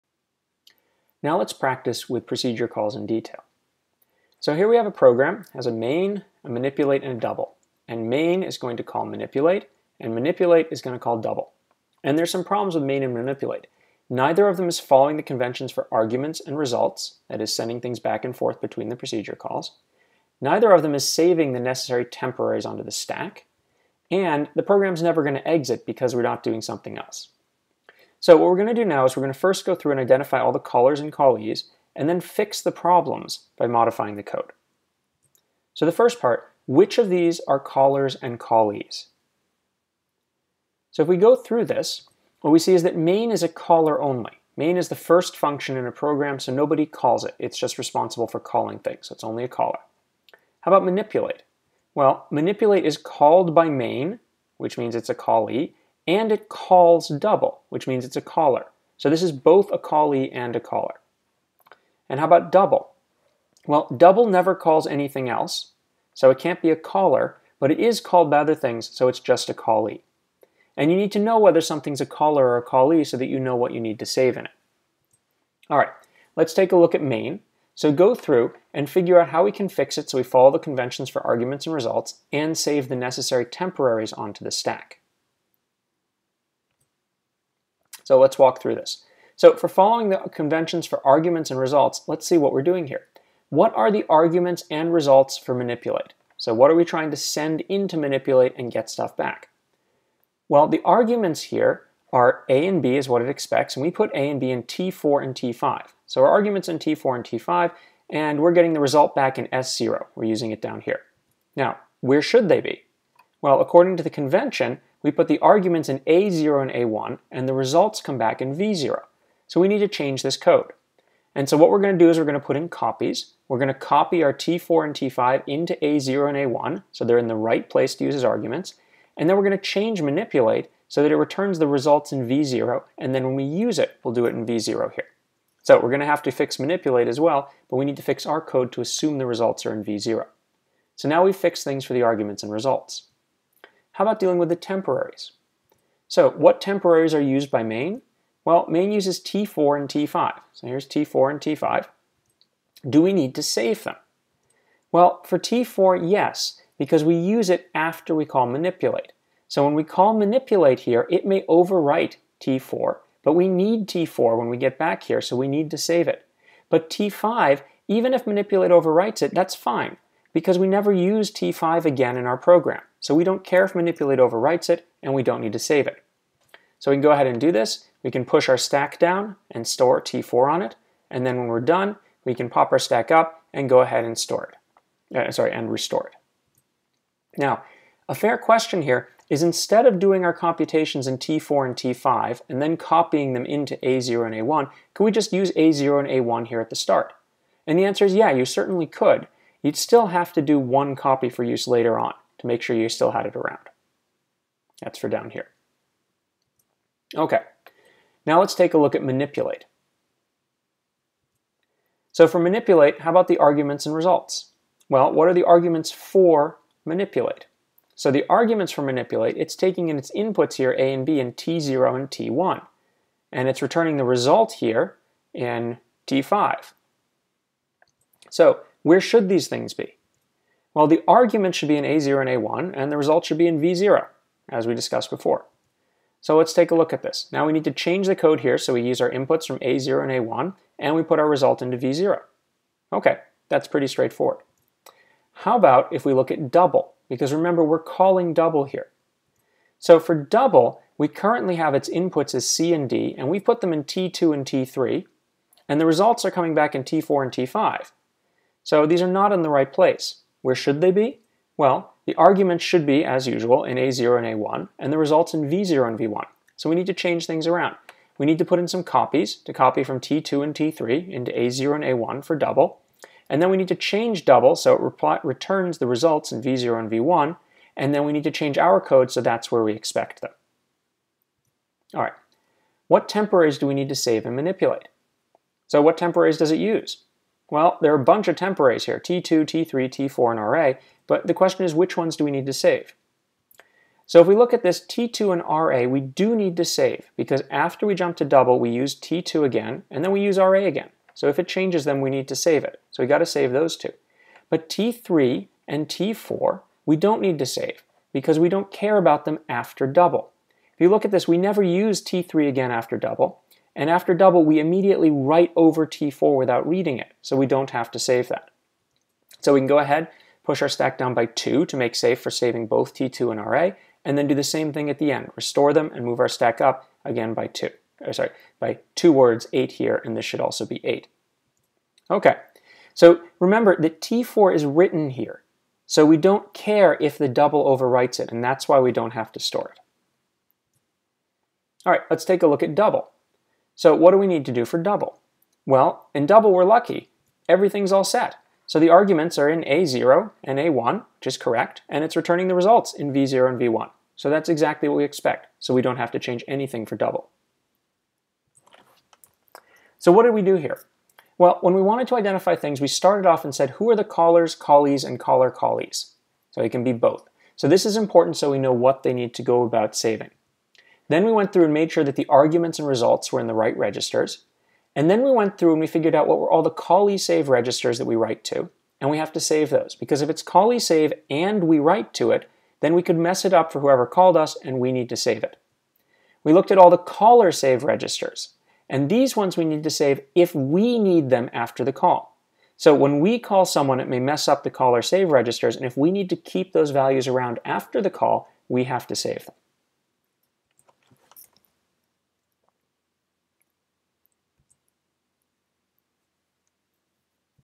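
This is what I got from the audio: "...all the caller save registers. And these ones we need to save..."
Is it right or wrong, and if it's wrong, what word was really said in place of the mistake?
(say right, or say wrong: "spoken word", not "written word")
right.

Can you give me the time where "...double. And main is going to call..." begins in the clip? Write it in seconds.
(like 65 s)
7 s.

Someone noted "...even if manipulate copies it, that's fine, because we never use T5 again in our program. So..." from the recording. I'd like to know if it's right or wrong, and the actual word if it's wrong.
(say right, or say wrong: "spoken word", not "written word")
wrong: "overwrites", not "copies".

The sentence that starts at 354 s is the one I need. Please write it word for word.
So that's exactly what we expect, so we don't have to change anything for double.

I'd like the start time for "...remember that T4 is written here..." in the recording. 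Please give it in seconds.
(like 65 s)
333 s.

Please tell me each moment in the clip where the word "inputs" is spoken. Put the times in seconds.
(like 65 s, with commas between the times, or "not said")
220 s, 239 s, 251 s.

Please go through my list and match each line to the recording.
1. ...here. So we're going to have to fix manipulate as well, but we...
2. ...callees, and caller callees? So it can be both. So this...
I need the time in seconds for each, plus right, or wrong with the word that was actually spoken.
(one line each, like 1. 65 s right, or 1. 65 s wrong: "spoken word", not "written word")
1. 134 s right
2. 364 s right.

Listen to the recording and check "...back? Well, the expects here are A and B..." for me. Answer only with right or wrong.
wrong.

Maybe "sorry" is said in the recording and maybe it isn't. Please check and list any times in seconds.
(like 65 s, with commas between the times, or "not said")
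185 s, 328 s.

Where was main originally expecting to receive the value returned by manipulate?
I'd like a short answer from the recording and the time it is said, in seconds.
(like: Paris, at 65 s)
S0, at 109 s.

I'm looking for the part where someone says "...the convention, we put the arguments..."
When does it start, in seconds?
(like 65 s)
114 s.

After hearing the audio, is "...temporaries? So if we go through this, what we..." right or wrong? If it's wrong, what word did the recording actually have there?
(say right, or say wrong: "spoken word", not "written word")
wrong: "callees", not "temporaries".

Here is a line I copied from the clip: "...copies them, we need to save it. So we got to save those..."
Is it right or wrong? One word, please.
wrong.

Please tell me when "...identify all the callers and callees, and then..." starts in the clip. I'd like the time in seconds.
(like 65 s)
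29 s.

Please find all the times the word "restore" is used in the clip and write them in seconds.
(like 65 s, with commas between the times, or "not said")
185 s, 325 s.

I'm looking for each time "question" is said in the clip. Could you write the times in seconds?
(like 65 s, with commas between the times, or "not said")
188 s, 291 s.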